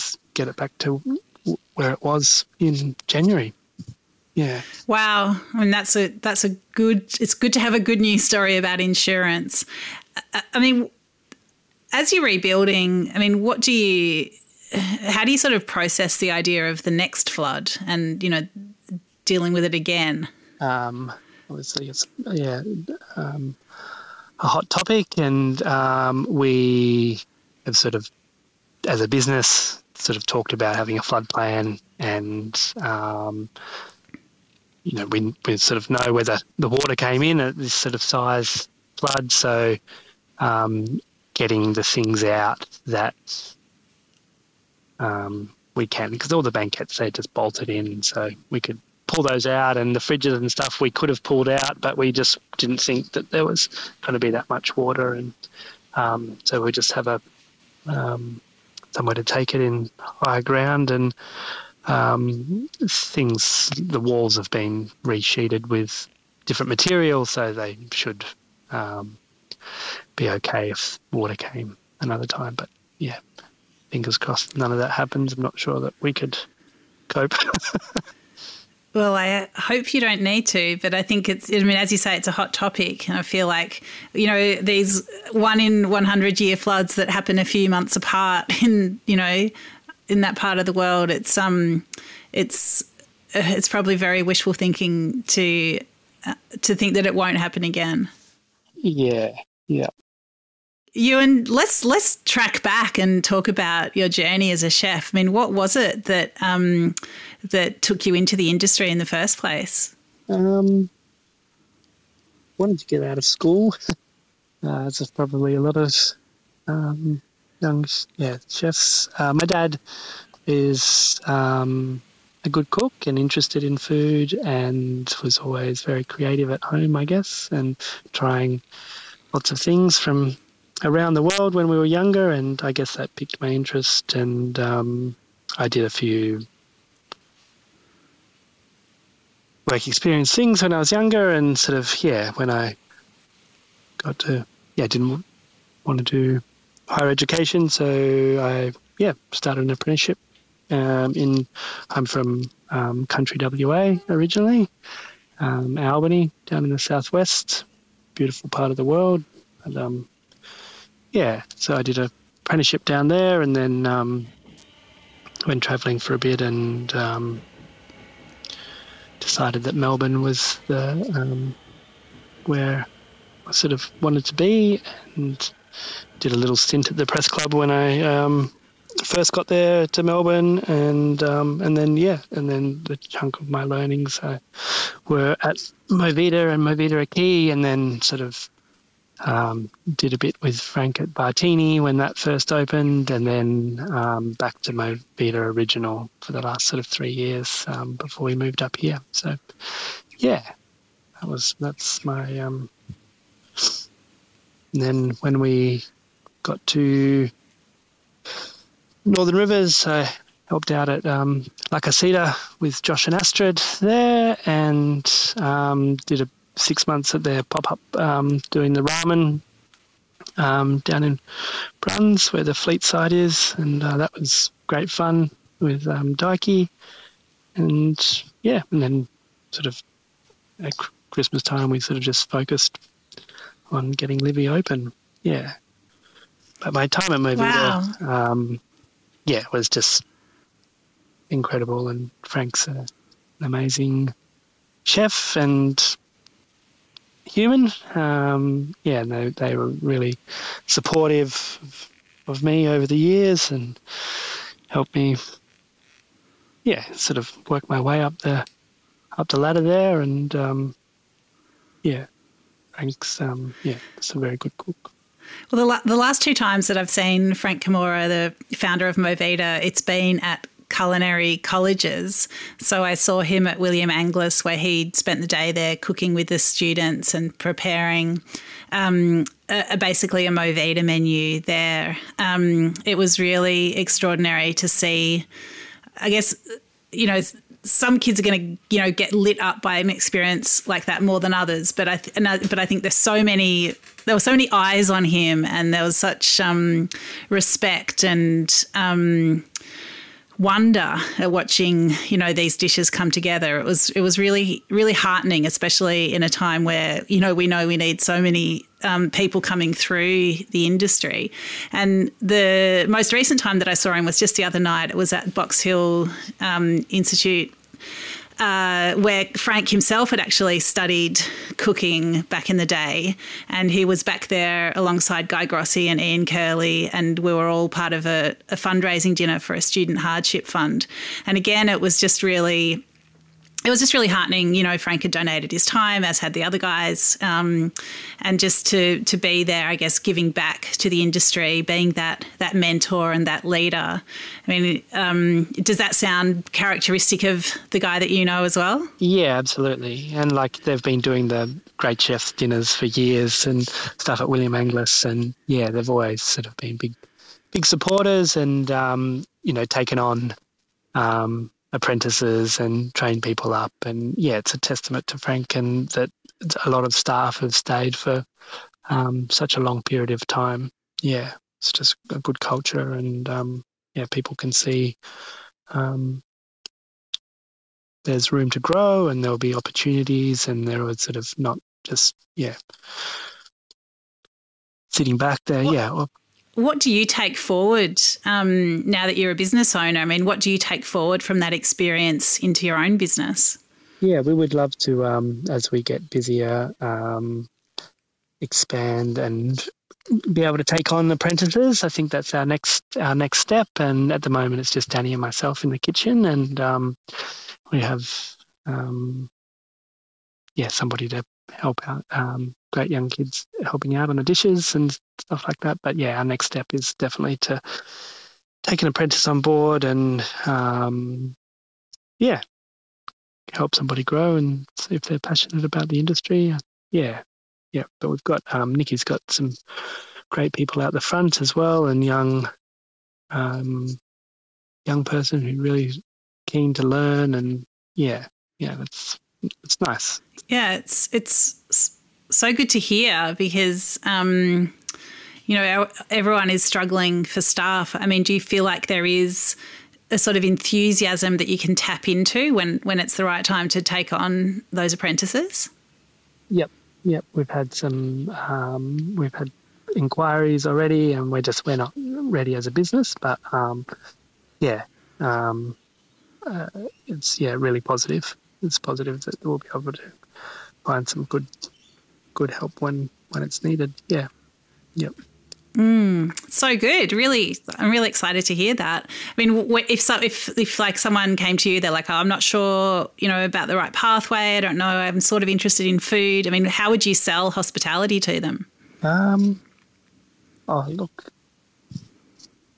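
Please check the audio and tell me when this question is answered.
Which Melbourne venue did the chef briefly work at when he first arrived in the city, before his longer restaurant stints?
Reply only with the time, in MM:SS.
02:56.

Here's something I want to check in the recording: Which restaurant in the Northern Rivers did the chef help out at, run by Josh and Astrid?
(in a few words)
La Casita.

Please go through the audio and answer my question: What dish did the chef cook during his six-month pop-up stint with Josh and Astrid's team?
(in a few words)
ramen.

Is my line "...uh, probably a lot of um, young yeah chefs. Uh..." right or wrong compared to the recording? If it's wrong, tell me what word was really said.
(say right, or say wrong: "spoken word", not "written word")
right.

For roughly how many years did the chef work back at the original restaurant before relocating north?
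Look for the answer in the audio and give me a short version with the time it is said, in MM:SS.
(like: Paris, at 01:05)
3, at 03:16.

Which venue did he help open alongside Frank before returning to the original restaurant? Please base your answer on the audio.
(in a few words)
Bartini.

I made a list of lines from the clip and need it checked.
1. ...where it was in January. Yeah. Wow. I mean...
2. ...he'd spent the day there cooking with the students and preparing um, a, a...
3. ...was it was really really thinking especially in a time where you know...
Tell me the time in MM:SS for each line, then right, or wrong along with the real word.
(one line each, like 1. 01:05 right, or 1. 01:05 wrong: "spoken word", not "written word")
1. 00:01 right
2. 04:34 right
3. 05:03 wrong: "heartening", not "thinking".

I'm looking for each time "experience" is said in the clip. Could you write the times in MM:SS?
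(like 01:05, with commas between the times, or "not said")
02:19, 04:49, 06:31.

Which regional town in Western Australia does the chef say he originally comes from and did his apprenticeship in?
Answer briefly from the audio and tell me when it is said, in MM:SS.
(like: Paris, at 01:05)
Albany, at 02:35.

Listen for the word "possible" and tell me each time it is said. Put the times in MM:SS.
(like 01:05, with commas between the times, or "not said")
not said.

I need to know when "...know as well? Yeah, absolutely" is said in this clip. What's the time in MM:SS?
05:48.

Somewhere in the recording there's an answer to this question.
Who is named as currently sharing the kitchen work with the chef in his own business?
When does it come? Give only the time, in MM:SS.
06:44.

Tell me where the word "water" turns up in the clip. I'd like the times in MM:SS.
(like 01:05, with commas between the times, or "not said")
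00:36, 00:54, 01:11.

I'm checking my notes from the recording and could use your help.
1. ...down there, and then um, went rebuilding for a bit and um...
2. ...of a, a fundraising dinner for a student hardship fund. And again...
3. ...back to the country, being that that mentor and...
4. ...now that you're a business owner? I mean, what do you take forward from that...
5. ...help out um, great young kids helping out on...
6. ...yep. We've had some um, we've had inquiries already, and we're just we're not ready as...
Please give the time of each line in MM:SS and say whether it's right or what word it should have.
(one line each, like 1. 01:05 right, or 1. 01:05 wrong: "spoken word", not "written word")
1. 02:42 wrong: "travelling", not "rebuilding"
2. 05:27 right
3. 05:40 wrong: "industry", not "country"
4. 06:28 right
5. 06:51 right
6. 07:37 right.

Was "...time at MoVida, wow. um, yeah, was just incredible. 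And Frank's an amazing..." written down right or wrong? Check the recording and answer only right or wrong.
right.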